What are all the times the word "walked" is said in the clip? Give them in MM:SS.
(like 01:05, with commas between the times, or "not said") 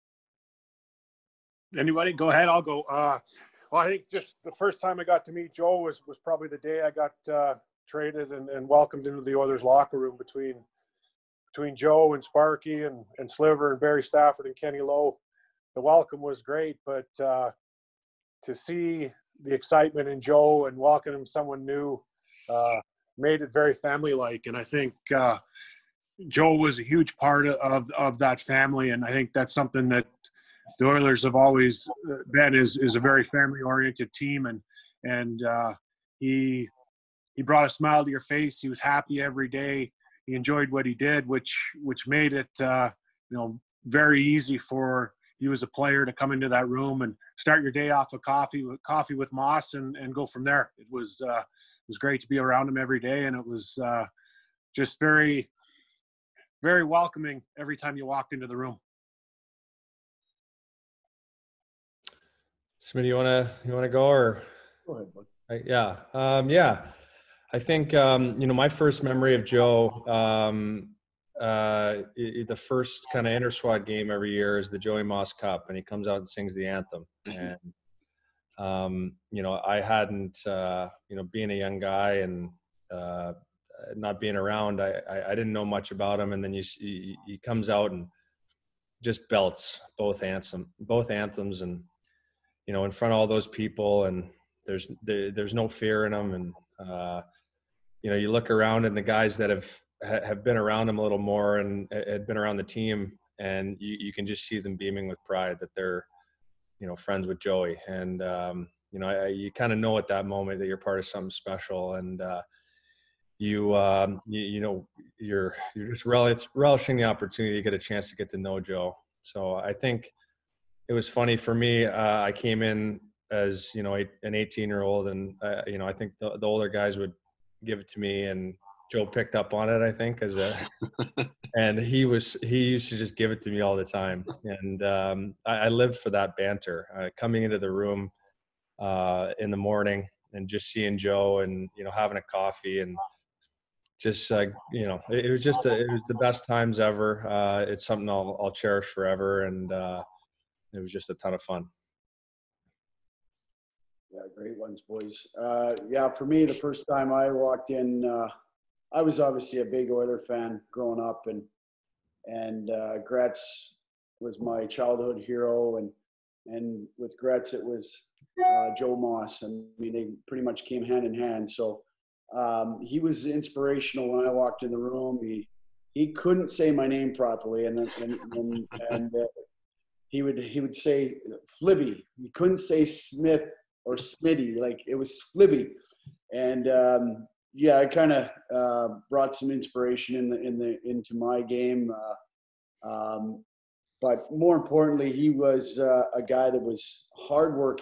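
00:58, 02:37, 02:54.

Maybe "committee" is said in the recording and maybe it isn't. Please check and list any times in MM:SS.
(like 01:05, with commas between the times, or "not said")
not said.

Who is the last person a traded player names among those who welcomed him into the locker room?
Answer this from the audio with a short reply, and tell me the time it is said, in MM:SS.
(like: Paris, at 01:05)
Kenny Lowe, at 00:14.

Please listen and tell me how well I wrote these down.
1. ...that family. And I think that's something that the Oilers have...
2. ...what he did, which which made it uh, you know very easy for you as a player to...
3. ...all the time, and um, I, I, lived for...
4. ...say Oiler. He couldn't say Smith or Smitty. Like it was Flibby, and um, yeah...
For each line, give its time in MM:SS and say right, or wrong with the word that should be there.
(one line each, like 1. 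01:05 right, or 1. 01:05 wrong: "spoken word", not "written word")
1. 00:28 right
2. 00:40 right
3. 02:13 right
4. 03:00 wrong: "Flibby", not "Oiler".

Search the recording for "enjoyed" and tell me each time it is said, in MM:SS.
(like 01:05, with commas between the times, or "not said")
00:40.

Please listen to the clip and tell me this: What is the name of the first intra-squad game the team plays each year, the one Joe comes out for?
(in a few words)
Joey Moss Cup.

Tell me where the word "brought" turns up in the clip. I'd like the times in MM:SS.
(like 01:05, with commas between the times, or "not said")
00:37, 03:09.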